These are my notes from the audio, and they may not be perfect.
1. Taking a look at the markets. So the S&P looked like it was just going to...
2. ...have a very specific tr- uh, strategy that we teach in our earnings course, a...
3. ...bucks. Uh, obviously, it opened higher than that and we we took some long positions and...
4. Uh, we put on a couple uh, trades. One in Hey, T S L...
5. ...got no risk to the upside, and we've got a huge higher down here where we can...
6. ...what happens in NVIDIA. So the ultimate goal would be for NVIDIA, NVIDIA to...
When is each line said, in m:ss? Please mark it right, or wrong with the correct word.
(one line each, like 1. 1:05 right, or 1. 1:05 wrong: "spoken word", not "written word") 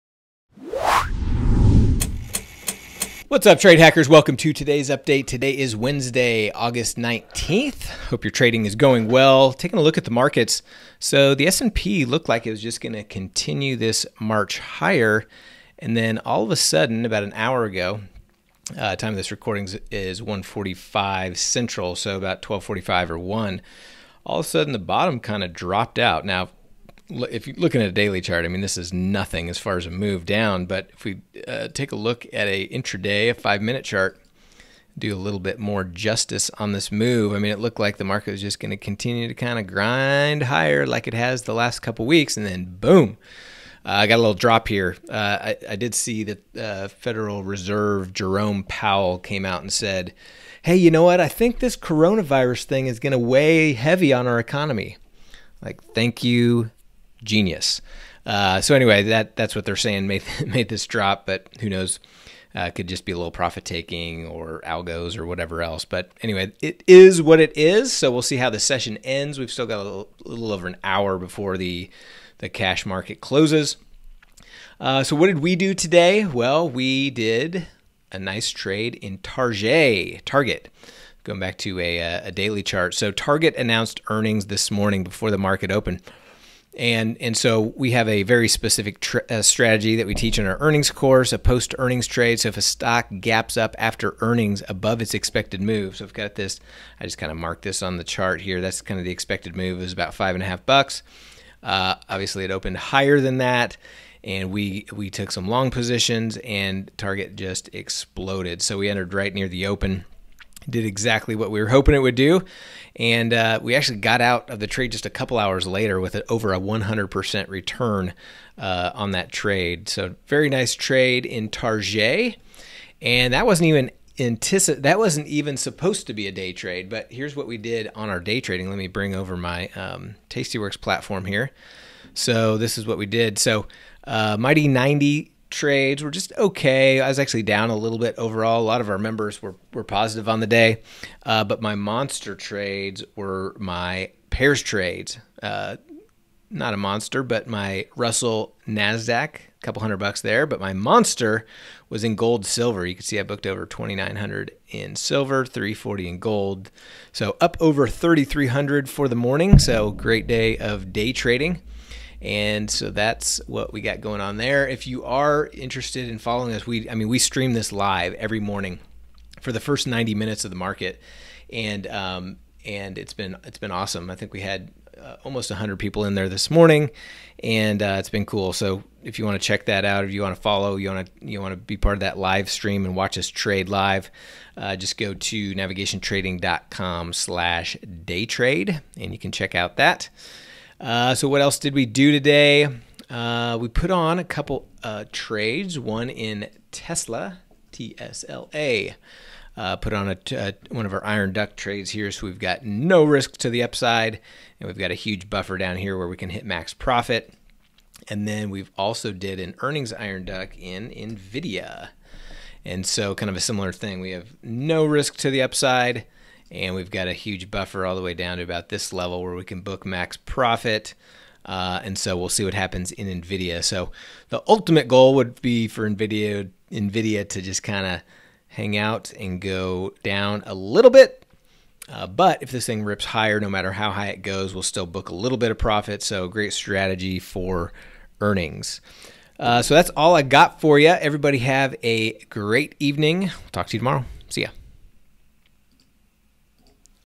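1. 0:09 right
2. 1:27 right
3. 1:40 right
4. 3:13 wrong: "Tesla", not "Hey"
5. 3:22 wrong: "buffer", not "higher"
6. 3:42 right.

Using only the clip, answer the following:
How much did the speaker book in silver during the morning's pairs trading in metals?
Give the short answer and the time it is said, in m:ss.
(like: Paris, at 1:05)
over $2,900, at 2:33.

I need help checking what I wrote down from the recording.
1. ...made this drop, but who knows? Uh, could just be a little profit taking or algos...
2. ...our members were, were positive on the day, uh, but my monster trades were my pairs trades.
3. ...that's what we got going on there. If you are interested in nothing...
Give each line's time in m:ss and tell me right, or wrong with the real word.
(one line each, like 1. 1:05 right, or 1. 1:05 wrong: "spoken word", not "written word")
1. 1:00 right
2. 2:18 right
3. 2:42 wrong: "following", not "nothing".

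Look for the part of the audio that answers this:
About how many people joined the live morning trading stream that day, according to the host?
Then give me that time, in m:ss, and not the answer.
2:55.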